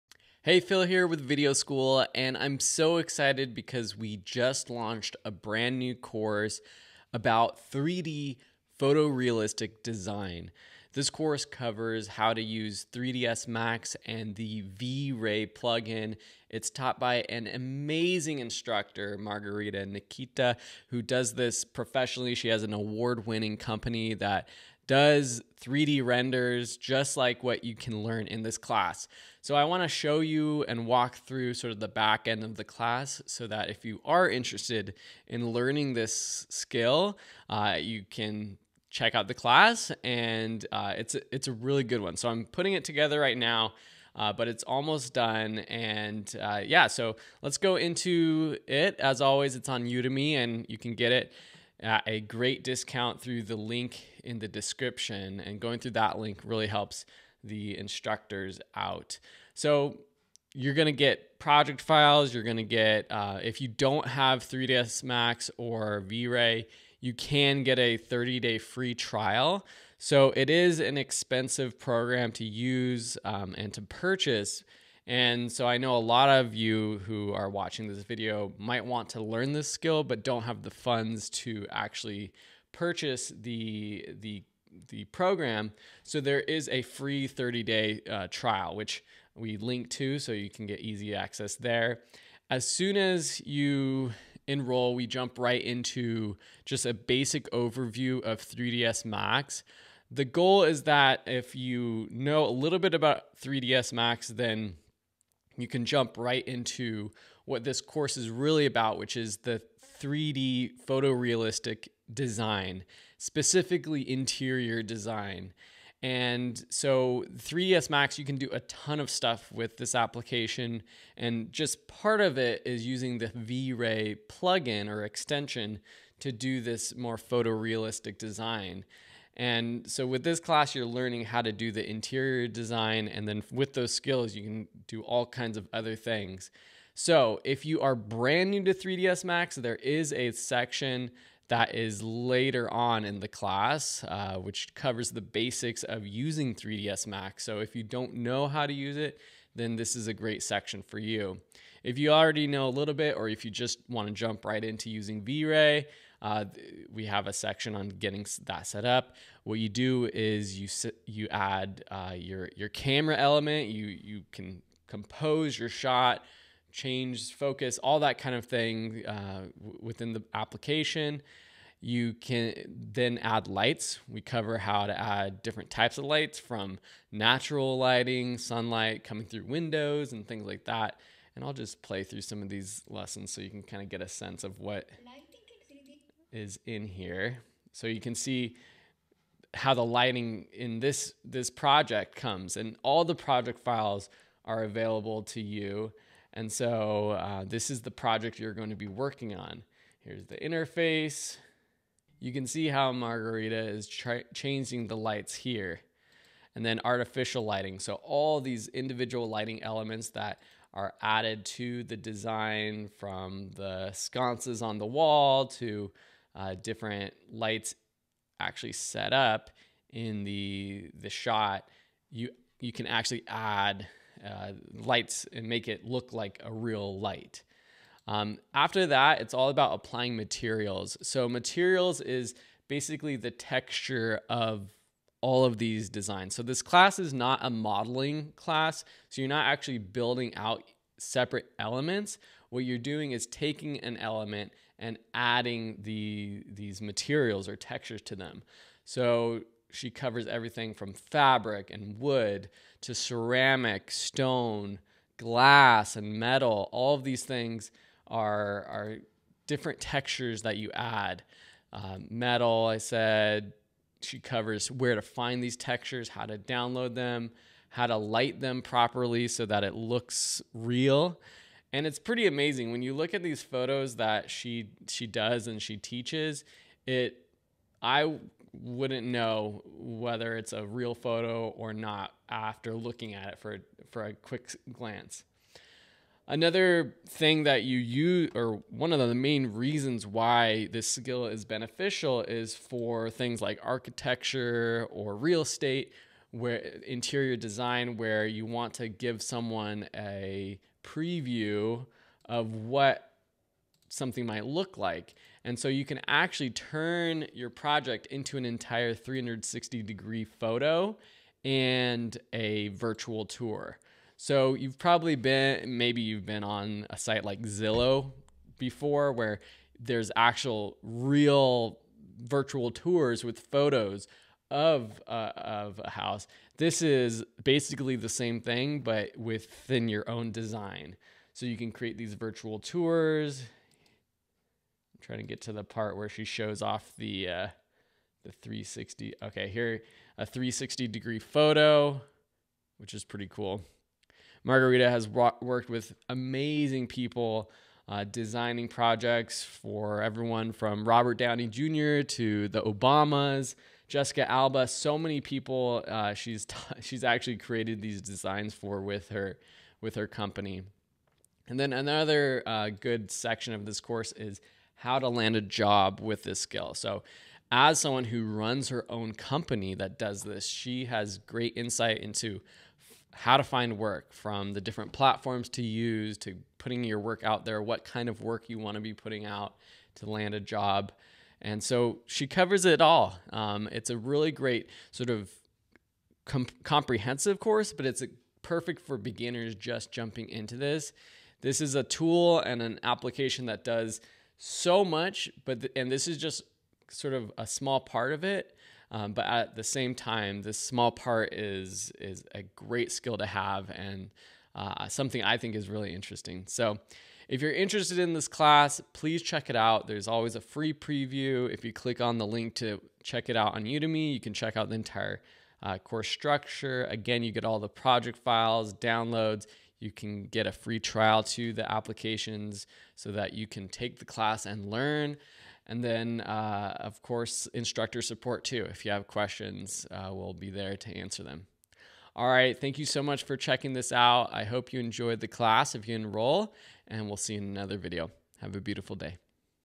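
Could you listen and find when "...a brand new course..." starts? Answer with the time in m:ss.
0:05.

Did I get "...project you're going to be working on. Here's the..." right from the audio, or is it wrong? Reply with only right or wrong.
right.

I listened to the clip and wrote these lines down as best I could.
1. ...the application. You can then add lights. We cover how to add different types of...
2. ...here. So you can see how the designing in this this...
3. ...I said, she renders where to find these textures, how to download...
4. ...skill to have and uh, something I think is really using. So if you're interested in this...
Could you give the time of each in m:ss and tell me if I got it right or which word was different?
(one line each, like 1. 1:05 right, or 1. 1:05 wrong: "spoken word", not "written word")
1. 2:50 right
2. 3:06 wrong: "lighting", not "designing"
3. 4:22 wrong: "covers", not "renders"
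4. 6:42 wrong: "interesting", not "using".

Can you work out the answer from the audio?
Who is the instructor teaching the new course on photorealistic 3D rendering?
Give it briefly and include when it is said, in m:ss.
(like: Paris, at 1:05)
Margarita Nikita, at 0:19.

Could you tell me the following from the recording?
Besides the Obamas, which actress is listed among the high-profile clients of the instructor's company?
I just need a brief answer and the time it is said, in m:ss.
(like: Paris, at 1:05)
Jessica Alba, at 5:53.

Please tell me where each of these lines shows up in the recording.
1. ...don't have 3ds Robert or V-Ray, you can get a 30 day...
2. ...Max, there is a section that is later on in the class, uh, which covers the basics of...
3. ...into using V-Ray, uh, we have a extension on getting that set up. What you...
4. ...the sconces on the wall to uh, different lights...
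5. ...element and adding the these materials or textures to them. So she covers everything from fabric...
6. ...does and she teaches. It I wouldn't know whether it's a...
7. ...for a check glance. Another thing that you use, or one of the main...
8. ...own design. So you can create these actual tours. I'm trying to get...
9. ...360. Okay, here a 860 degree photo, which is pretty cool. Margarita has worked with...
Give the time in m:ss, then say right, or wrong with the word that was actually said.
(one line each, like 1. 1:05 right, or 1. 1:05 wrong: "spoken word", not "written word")
1. 1:03 wrong: "Max", not "Robert"
2. 2:19 right
3. 2:34 wrong: "section", not "extension"
4. 3:33 right
5. 4:03 right
6. 4:35 right
7. 4:43 wrong: "quick", not "check"
8. 5:30 wrong: "virtual", not "actual"
9. 5:38 wrong: "360", not "860".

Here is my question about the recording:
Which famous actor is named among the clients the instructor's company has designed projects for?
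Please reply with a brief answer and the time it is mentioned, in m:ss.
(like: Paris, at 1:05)
Robert Downey Jr., at 5:50.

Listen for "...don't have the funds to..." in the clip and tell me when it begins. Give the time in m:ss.
1:20.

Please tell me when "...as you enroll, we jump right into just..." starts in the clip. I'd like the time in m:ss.
1:32.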